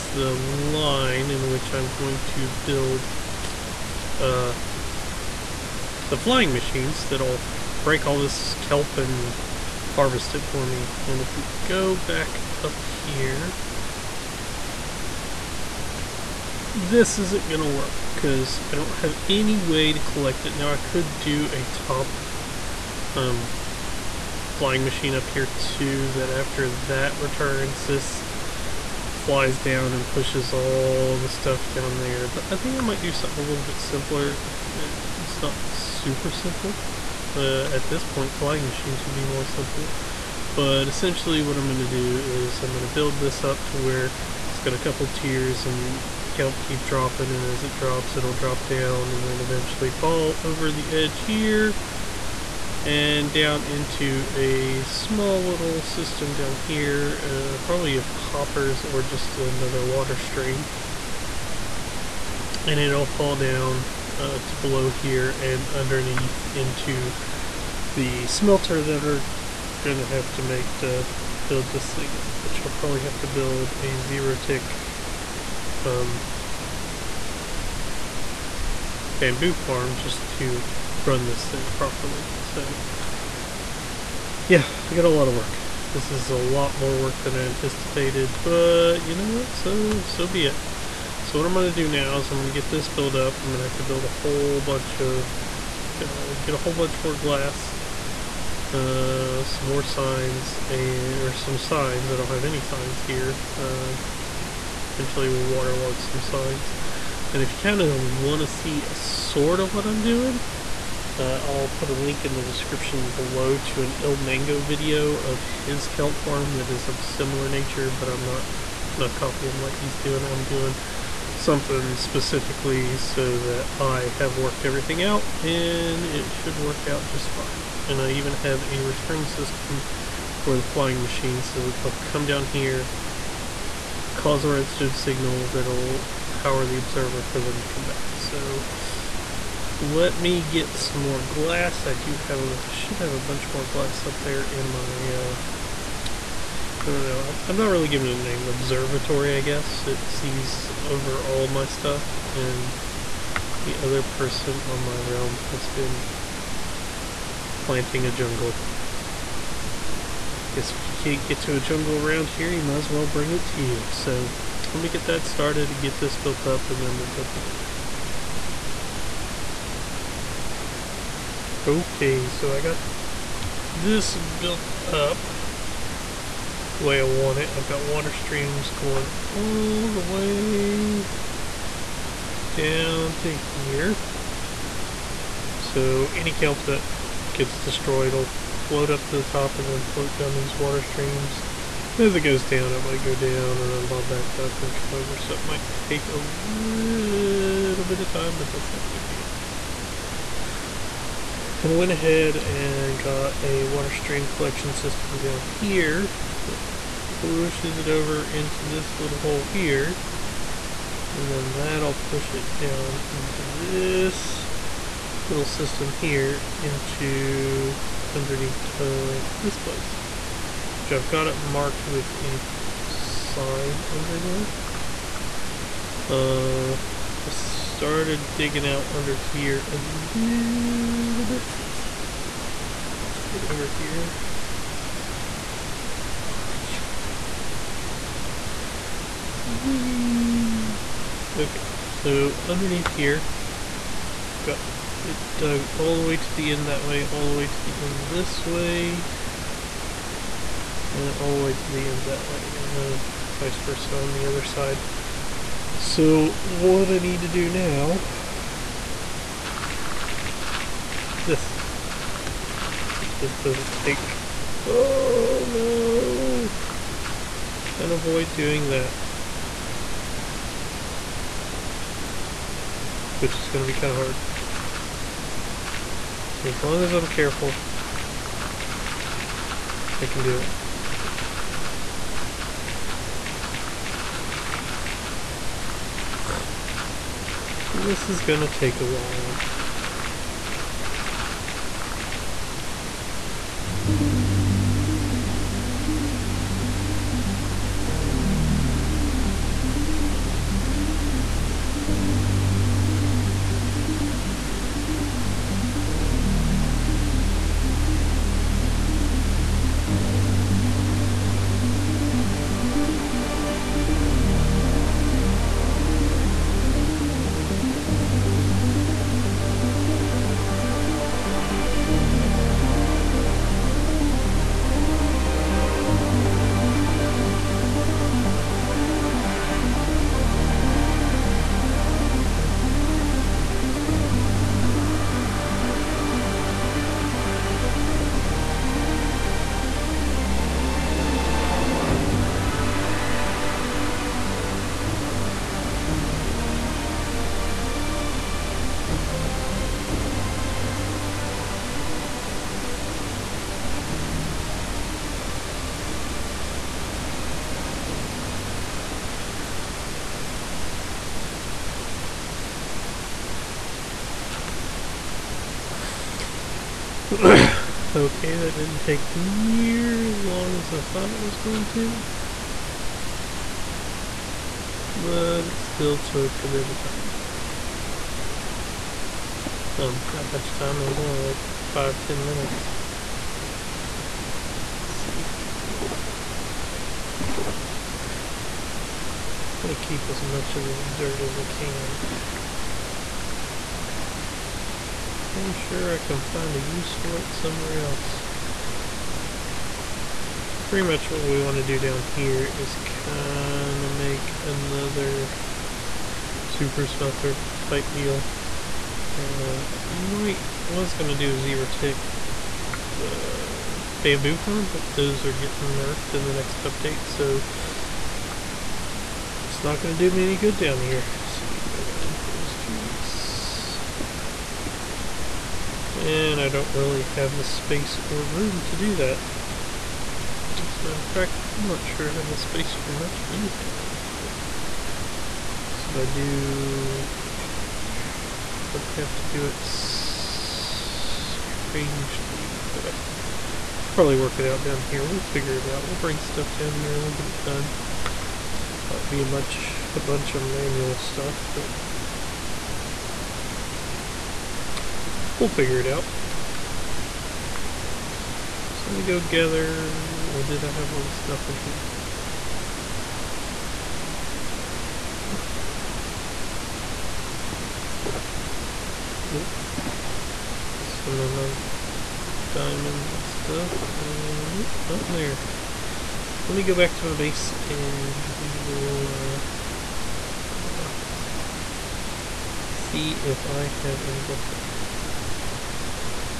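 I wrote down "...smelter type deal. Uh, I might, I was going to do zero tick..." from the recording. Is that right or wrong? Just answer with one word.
right.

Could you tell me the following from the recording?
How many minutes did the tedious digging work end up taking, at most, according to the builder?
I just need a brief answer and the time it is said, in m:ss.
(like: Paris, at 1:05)
10 minutes, at 6:21.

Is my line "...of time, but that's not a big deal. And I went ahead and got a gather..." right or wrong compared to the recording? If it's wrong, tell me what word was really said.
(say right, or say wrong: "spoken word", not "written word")
wrong: "water", not "gather".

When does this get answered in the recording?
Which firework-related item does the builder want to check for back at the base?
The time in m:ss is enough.
8:00.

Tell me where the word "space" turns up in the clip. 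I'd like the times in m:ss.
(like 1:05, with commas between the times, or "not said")
7:07, 7:12.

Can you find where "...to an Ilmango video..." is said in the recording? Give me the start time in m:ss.
1:53.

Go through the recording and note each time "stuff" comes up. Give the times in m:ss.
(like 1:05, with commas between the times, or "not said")
0:31, 2:31, 7:26, 7:30, 7:41, 7:53.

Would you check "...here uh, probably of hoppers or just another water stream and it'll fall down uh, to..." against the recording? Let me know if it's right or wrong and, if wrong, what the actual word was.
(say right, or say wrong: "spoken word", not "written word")
right.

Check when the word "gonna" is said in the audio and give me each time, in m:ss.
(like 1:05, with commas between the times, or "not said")
1:09, 4:48, 6:29.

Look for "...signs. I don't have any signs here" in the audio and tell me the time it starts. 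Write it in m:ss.
1:41.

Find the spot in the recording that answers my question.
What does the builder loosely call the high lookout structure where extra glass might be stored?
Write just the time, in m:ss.
2:28.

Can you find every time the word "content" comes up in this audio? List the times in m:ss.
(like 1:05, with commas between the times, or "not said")
not said.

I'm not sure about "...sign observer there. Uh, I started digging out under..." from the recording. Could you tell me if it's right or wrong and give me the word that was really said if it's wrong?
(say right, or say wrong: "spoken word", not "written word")
wrong: "under", not "observer".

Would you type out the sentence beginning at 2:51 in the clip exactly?
Okay, so I got this built up the way I want it.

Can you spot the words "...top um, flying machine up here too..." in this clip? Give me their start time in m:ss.
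0:21.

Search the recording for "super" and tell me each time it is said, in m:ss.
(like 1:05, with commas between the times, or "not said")
0:35, 6:46.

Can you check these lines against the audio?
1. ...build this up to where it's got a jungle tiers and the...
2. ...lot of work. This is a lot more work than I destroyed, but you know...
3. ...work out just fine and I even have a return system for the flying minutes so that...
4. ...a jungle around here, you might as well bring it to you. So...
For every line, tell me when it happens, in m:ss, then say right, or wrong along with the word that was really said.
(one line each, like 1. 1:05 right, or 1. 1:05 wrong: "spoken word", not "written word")
1. 0:42 wrong: "couple", not "jungle"
2. 1:25 wrong: "anticipated", not "destroyed"
3. 2:06 wrong: "machines", not "minutes"
4. 2:41 right.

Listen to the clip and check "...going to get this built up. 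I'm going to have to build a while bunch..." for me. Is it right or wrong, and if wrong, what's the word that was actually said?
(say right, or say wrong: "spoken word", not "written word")
wrong: "whole", not "while".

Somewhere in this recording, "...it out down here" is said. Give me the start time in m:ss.
7:24.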